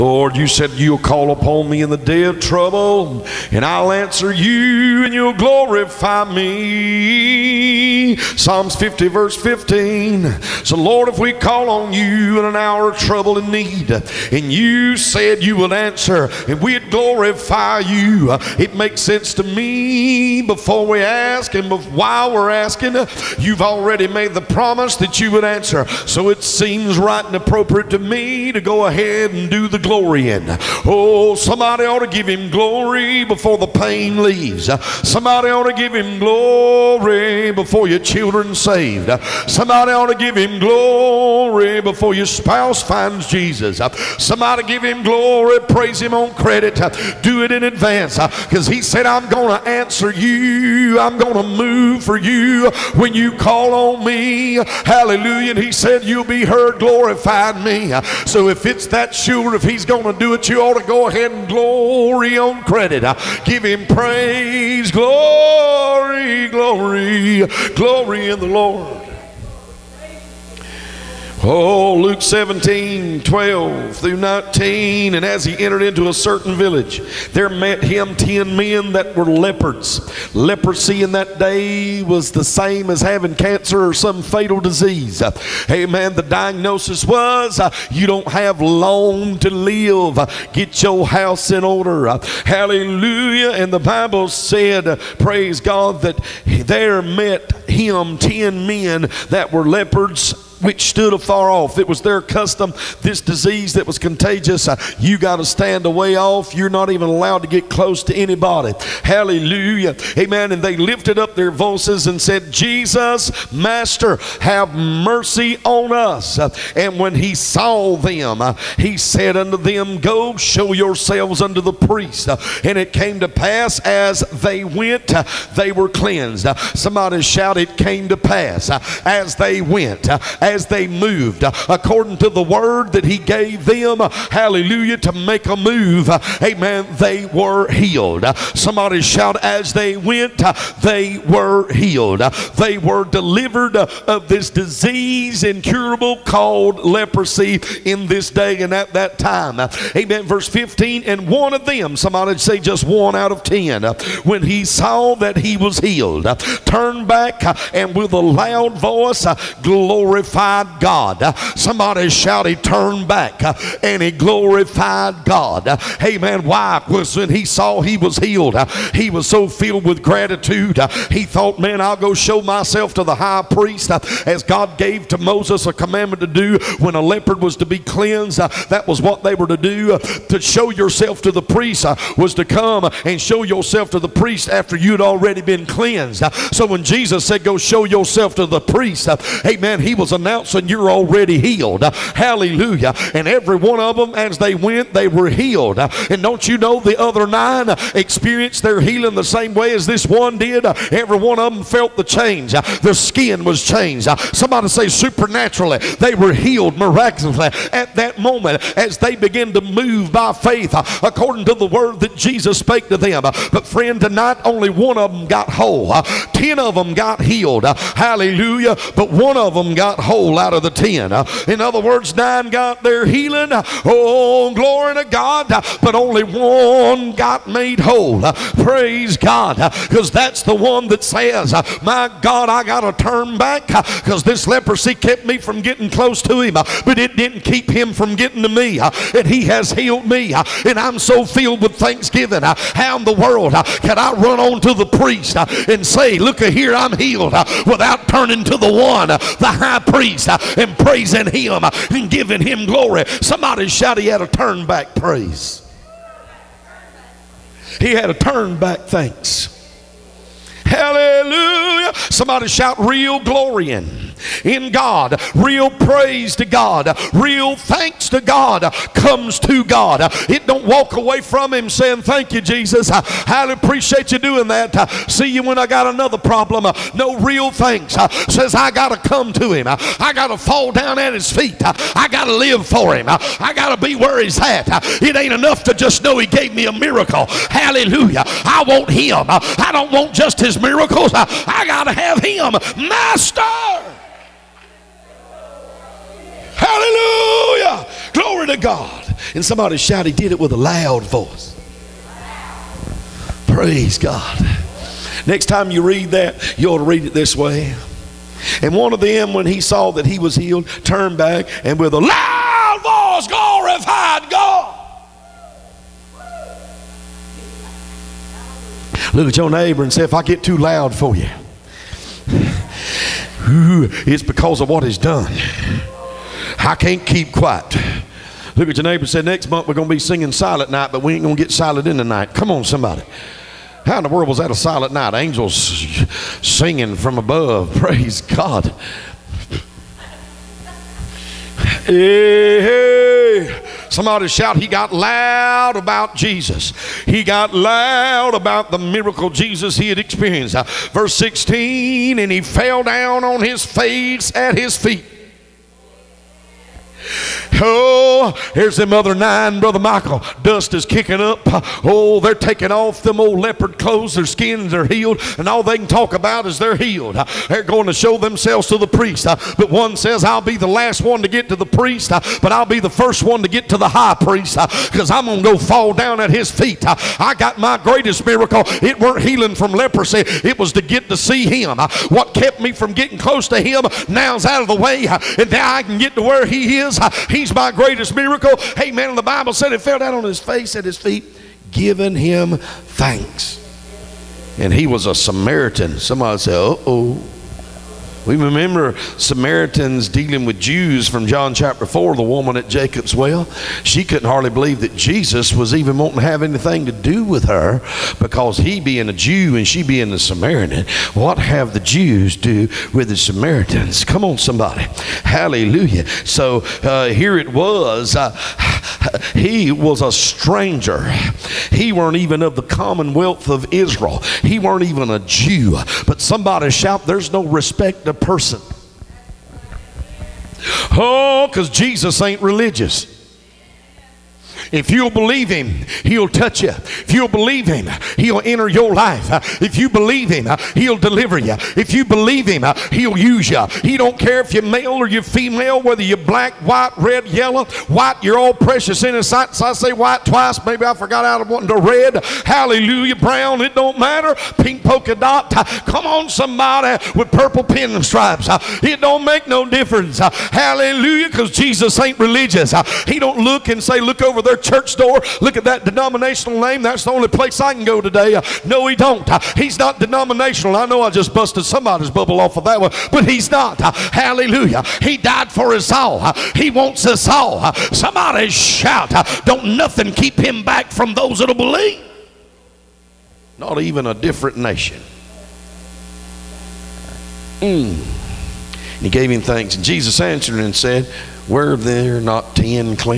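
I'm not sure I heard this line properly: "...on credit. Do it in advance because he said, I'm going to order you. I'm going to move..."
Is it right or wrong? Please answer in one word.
wrong.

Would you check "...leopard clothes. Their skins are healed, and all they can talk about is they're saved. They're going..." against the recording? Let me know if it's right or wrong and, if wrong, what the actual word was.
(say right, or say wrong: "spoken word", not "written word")
wrong: "healed", not "saved".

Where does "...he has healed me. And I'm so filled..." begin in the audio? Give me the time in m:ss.
3:59.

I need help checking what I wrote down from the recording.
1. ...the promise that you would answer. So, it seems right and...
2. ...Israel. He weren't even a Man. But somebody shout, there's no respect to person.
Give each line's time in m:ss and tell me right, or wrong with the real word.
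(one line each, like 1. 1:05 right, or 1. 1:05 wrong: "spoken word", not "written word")
1. 0:24 right
2. 7:03 wrong: "Jew", not "Man".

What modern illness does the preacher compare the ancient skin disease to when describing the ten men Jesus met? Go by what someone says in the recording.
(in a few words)
cancer.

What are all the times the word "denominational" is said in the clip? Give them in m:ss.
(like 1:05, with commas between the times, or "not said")
7:45, 7:49.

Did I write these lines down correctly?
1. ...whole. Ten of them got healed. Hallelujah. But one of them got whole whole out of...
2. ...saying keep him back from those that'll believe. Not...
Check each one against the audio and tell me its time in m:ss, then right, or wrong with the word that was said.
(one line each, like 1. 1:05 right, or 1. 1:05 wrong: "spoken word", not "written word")
1. 3:35 right
2. 7:59 wrong: "nothing", not "saying".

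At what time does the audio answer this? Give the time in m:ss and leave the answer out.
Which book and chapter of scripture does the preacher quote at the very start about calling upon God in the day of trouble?
0:08.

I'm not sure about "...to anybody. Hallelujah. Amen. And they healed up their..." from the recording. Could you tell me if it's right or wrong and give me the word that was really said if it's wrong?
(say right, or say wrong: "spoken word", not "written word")
wrong: "lifted", not "healed".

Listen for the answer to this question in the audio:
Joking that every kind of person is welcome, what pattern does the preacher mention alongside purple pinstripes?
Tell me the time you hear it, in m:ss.
7:34.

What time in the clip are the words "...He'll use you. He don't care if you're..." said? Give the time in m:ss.
7:22.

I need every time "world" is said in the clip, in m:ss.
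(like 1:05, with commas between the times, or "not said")
4:03, 5:34.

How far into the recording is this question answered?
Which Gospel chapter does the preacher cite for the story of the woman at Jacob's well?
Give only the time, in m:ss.
6:41.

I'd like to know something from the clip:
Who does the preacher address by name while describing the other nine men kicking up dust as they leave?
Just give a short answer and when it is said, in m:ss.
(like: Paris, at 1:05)
Brother Michael, at 5:59.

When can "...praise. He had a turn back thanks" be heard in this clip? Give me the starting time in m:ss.
4:14.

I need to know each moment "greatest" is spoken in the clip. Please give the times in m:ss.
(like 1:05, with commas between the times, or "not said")
6:17, 6:27.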